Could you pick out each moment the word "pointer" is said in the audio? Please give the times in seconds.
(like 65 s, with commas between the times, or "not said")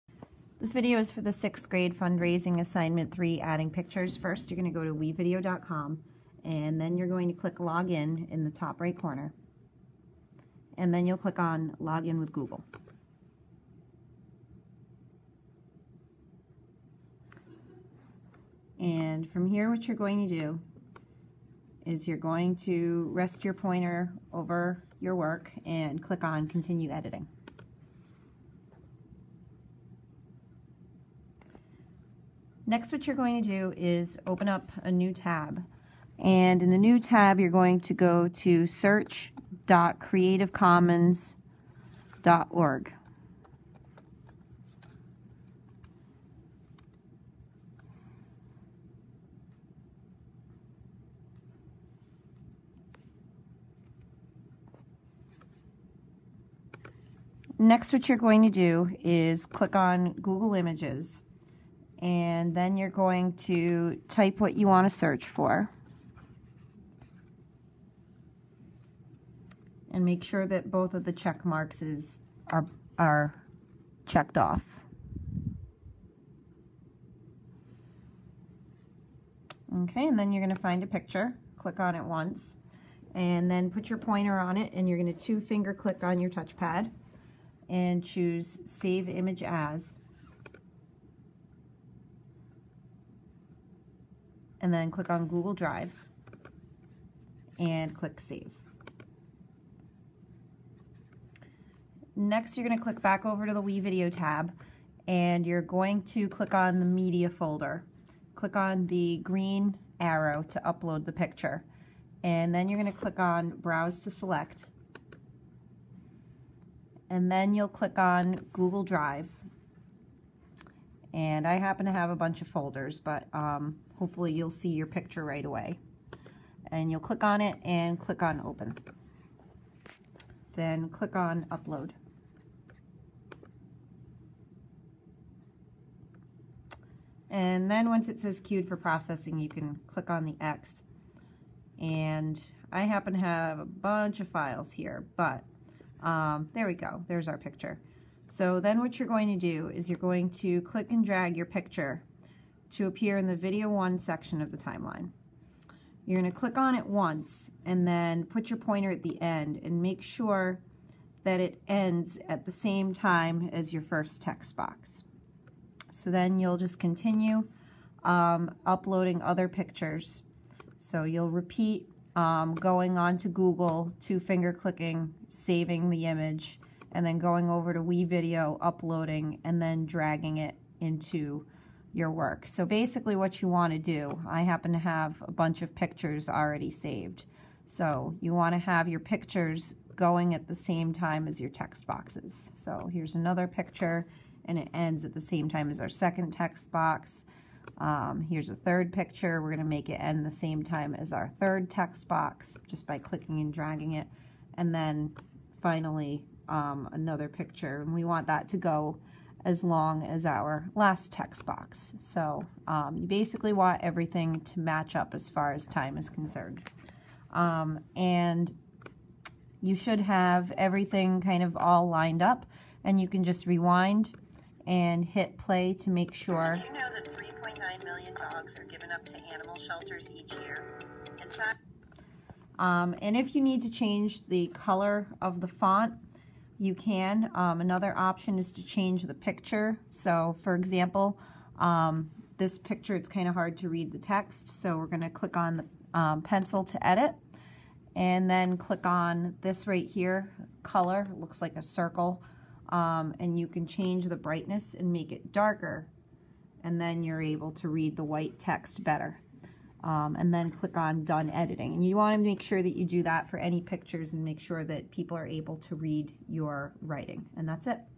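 23 s, 83 s, 158 s.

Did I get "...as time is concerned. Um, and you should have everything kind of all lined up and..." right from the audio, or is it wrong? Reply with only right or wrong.
right.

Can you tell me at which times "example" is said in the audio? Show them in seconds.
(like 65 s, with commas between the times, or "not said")
240 s.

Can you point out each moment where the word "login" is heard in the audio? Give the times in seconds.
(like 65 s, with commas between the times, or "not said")
7 s, 11 s.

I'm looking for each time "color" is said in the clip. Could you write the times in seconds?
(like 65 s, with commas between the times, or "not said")
234 s, 250 s.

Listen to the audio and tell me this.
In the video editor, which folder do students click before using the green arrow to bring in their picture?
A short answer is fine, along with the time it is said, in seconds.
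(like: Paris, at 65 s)
Media folder, at 106 s.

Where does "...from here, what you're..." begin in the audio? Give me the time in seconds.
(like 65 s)
19 s.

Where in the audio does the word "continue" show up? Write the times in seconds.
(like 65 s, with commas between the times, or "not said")
26 s, 166 s.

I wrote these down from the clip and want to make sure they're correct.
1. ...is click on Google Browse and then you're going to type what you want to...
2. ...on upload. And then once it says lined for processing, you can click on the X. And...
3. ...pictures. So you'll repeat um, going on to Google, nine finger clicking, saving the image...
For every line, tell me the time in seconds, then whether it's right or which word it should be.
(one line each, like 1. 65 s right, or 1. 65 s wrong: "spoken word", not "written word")
1. 59 s wrong: "Images", not "Browse"
2. 131 s wrong: "queued", not "lined"
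3. 169 s wrong: "two", not "nine".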